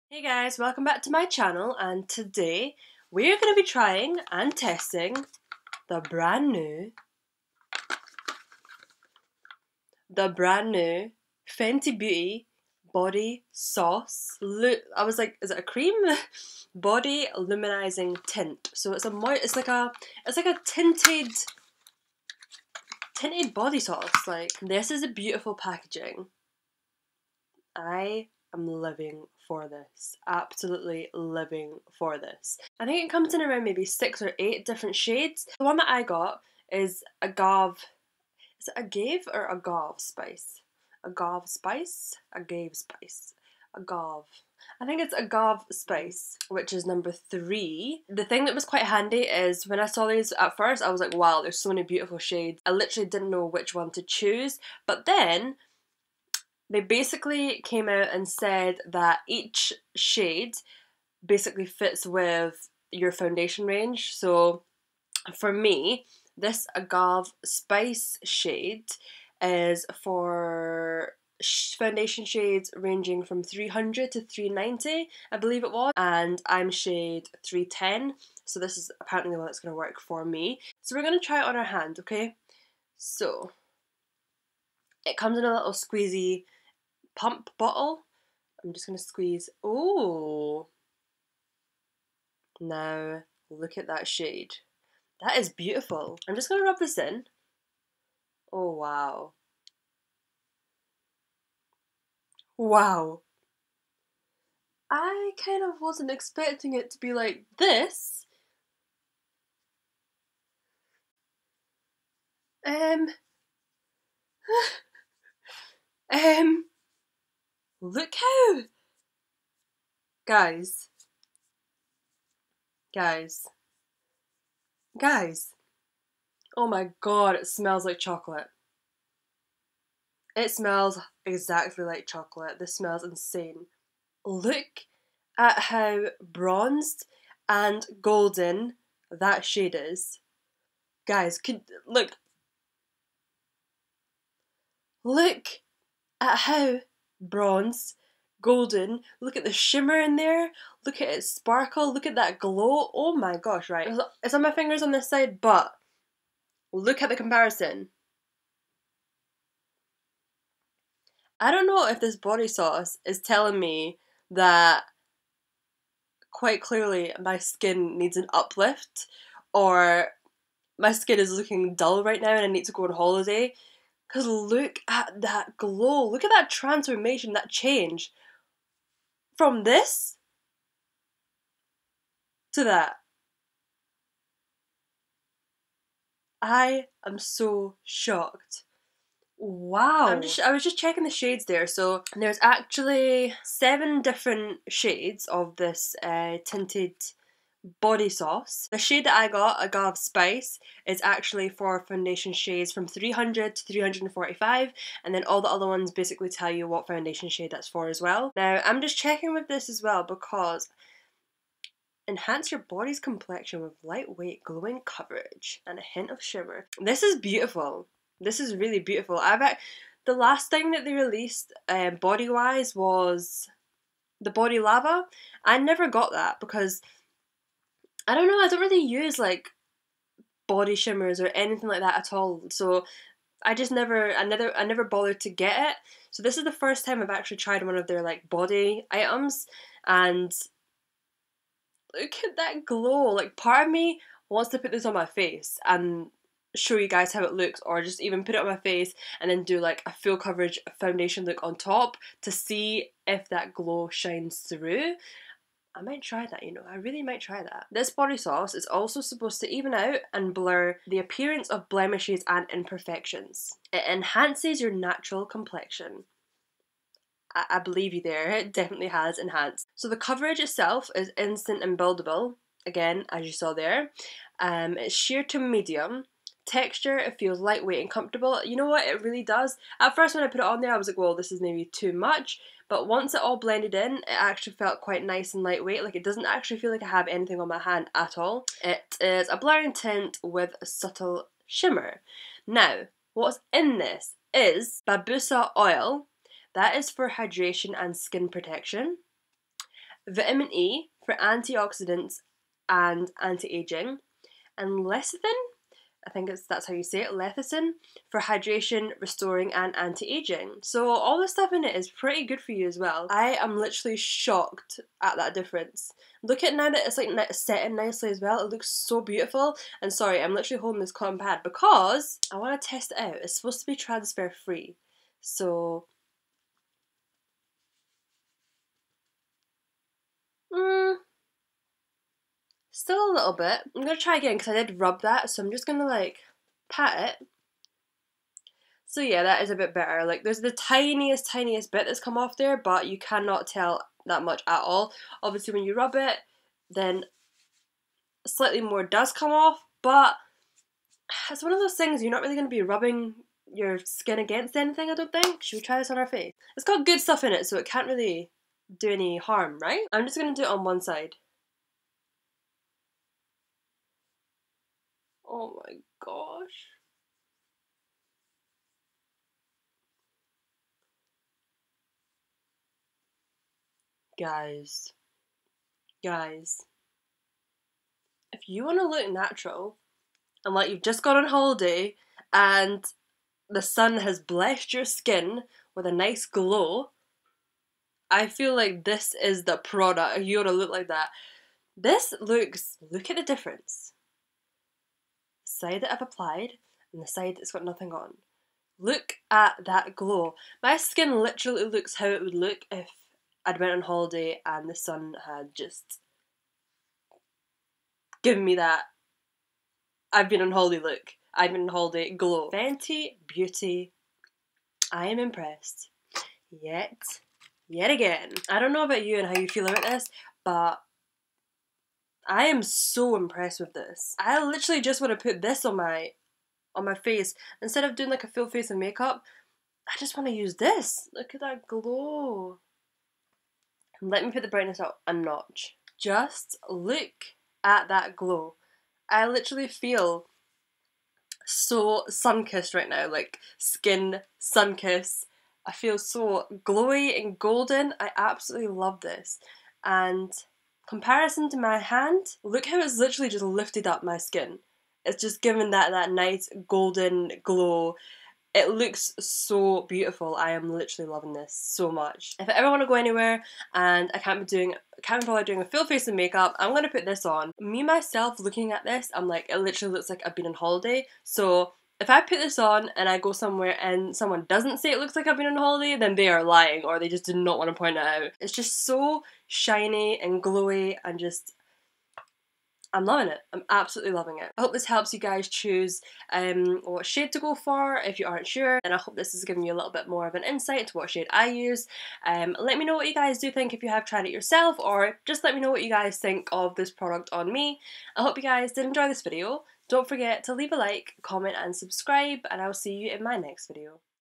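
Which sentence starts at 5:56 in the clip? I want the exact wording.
It's got good stuff in it, so it can't really do any harm, right?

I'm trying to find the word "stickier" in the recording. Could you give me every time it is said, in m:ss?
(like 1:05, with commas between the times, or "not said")
not said.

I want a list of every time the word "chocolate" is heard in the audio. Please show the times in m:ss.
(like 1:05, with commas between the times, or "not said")
2:07, 2:12.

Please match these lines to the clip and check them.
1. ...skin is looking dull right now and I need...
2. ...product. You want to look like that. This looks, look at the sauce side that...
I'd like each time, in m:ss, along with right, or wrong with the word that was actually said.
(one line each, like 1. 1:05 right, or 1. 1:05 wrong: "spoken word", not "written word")
1. 2:50 right
2. 6:29 wrong: "difference", not "sauce".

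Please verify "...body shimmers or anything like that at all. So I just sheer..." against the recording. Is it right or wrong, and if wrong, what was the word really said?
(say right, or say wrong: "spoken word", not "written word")
wrong: "never", not "sheer".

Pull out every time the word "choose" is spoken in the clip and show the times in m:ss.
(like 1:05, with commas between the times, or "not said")
0:54, 8:05.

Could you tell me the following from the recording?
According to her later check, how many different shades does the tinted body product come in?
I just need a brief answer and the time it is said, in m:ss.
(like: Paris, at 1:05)
7, at 3:13.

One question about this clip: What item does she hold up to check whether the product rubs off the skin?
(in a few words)
Cotton pad.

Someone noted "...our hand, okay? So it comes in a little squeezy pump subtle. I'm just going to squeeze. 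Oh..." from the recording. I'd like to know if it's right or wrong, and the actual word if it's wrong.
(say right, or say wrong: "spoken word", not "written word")
wrong: "bottle", not "subtle".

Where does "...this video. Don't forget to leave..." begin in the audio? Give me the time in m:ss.
8:19.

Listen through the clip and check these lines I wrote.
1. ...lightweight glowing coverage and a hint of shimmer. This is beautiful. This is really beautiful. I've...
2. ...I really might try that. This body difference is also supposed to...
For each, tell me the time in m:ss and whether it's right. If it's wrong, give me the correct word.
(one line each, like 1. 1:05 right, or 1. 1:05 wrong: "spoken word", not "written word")
1. 3:33 right
2. 4:16 wrong: "sauce", not "difference".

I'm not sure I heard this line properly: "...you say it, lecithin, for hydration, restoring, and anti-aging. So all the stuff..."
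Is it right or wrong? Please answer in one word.
right.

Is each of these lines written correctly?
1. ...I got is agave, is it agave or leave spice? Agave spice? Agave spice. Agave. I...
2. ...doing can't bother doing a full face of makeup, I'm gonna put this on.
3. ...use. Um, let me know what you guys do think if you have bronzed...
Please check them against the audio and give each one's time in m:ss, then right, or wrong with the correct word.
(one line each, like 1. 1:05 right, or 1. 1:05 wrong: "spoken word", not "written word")
1. 0:35 wrong: "agave", not "leave"
2. 7:44 right
3. 8:11 wrong: "tried", not "bronzed".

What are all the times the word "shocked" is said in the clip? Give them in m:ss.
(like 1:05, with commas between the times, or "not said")
3:07, 5:13.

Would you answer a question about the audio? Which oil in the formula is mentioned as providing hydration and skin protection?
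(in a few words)
Babassu oil.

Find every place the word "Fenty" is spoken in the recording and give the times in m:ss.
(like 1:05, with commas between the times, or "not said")
0:11, 6:52.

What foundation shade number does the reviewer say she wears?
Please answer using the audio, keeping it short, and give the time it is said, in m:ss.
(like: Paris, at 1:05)
310, at 1:16.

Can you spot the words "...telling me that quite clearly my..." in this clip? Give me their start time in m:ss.
2:43.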